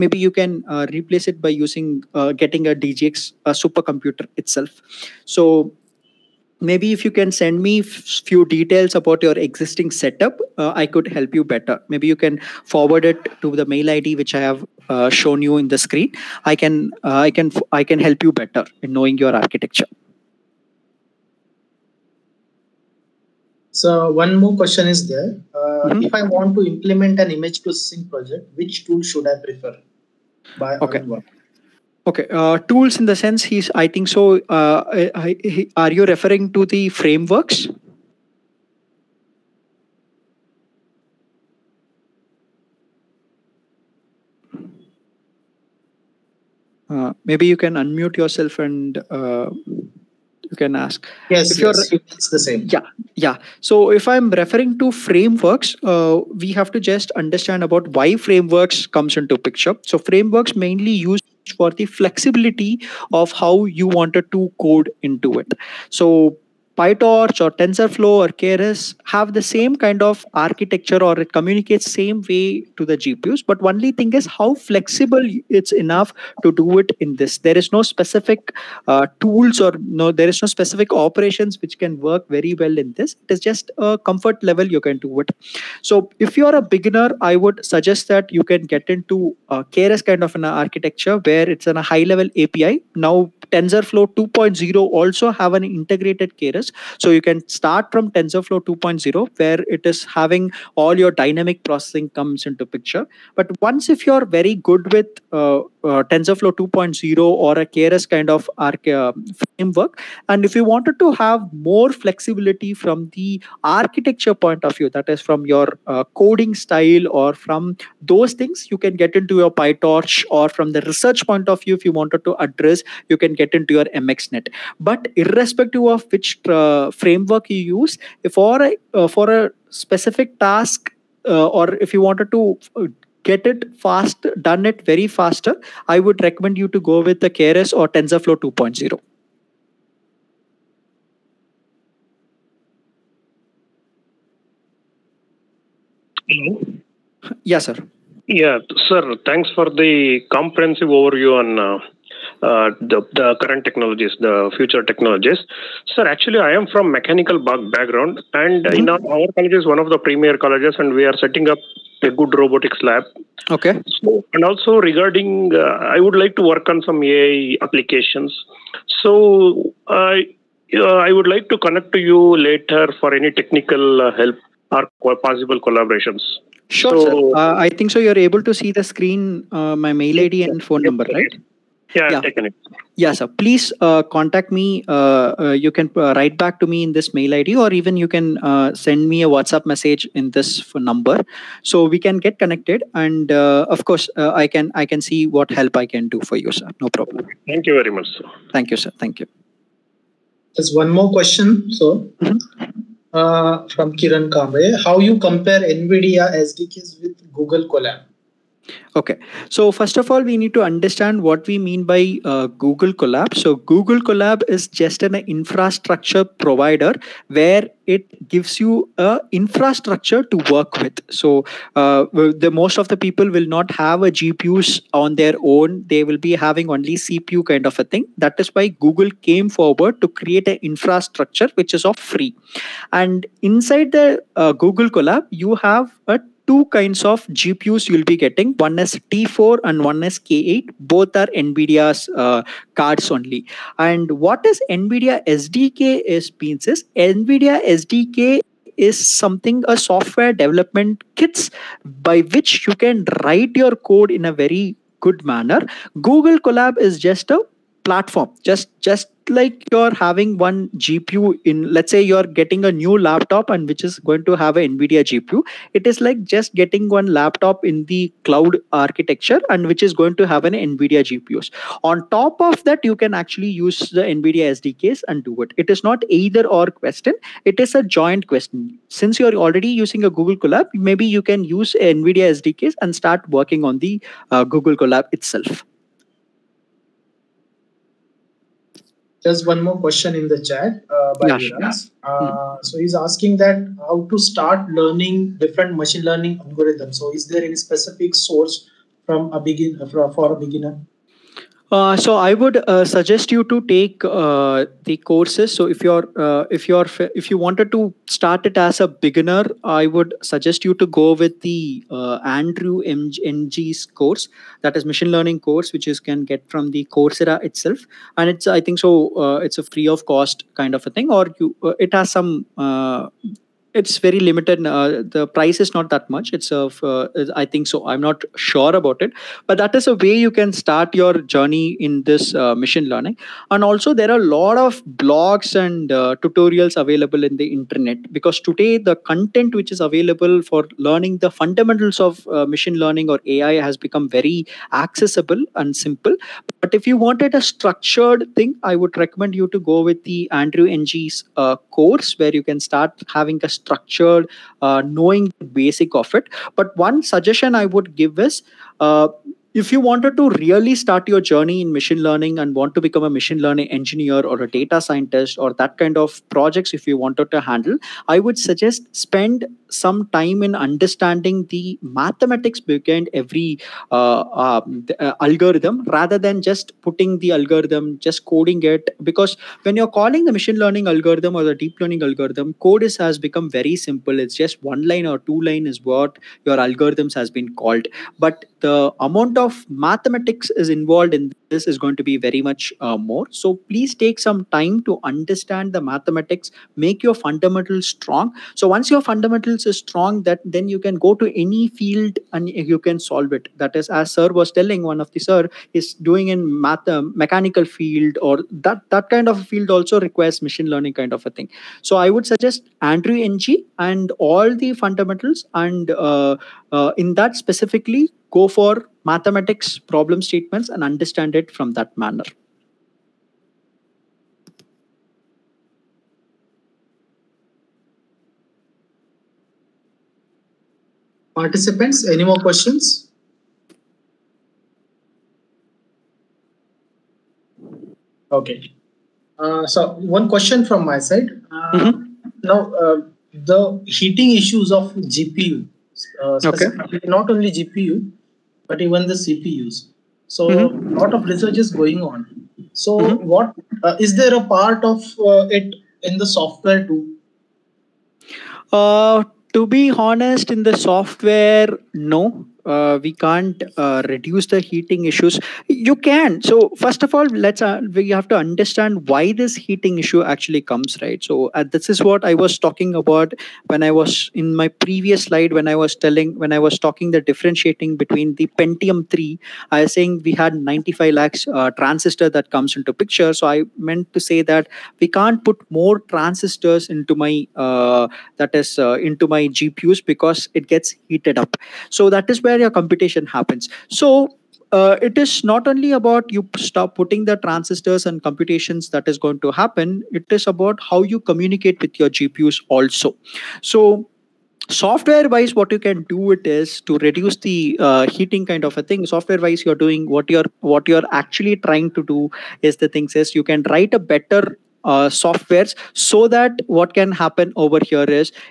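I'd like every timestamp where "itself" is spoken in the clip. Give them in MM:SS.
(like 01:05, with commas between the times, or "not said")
00:04, 04:45, 05:17.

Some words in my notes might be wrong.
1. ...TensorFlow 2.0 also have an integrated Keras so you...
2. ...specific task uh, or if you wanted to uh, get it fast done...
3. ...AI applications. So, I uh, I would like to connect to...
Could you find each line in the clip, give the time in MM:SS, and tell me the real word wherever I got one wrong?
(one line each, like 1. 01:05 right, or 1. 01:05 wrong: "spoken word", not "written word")
1. 01:33 right
2. 02:09 right
3. 02:47 right.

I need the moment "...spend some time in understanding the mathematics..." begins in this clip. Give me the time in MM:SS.
06:09.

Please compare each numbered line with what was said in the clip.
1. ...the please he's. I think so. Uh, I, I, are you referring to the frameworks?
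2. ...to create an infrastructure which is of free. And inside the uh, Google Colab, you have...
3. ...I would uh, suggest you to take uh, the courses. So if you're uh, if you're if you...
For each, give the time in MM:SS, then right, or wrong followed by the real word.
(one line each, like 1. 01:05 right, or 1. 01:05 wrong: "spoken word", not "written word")
1. 00:33 wrong: "sense", not "please"
2. 03:50 right
3. 05:02 right.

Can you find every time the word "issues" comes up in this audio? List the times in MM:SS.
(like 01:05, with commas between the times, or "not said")
07:24, 07:45, 07:49.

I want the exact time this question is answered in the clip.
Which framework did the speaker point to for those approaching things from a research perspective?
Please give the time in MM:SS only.
02:03.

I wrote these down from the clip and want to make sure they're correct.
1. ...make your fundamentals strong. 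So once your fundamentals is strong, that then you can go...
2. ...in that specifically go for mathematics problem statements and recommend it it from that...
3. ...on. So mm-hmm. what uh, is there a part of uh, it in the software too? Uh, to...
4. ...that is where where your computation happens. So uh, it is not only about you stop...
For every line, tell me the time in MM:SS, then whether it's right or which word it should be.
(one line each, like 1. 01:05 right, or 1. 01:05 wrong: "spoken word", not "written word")
1. 06:36 right
2. 06:57 wrong: "understand", not "recommend"
3. 07:32 right
4. 08:12 right.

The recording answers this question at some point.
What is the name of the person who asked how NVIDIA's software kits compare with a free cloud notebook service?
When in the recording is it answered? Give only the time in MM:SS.
03:23.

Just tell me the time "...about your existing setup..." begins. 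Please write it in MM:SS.
00:08.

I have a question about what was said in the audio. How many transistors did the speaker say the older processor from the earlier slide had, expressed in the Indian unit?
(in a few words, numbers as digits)
95 lakhs.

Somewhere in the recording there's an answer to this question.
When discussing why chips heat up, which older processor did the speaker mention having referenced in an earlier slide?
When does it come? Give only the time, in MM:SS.
07:58.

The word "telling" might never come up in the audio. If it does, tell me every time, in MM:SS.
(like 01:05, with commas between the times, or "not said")
06:44, 07:55.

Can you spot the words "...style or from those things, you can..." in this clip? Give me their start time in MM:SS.
01:56.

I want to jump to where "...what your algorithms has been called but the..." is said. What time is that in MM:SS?
06:25.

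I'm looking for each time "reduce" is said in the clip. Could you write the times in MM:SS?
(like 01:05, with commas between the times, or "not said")
07:44, 08:26.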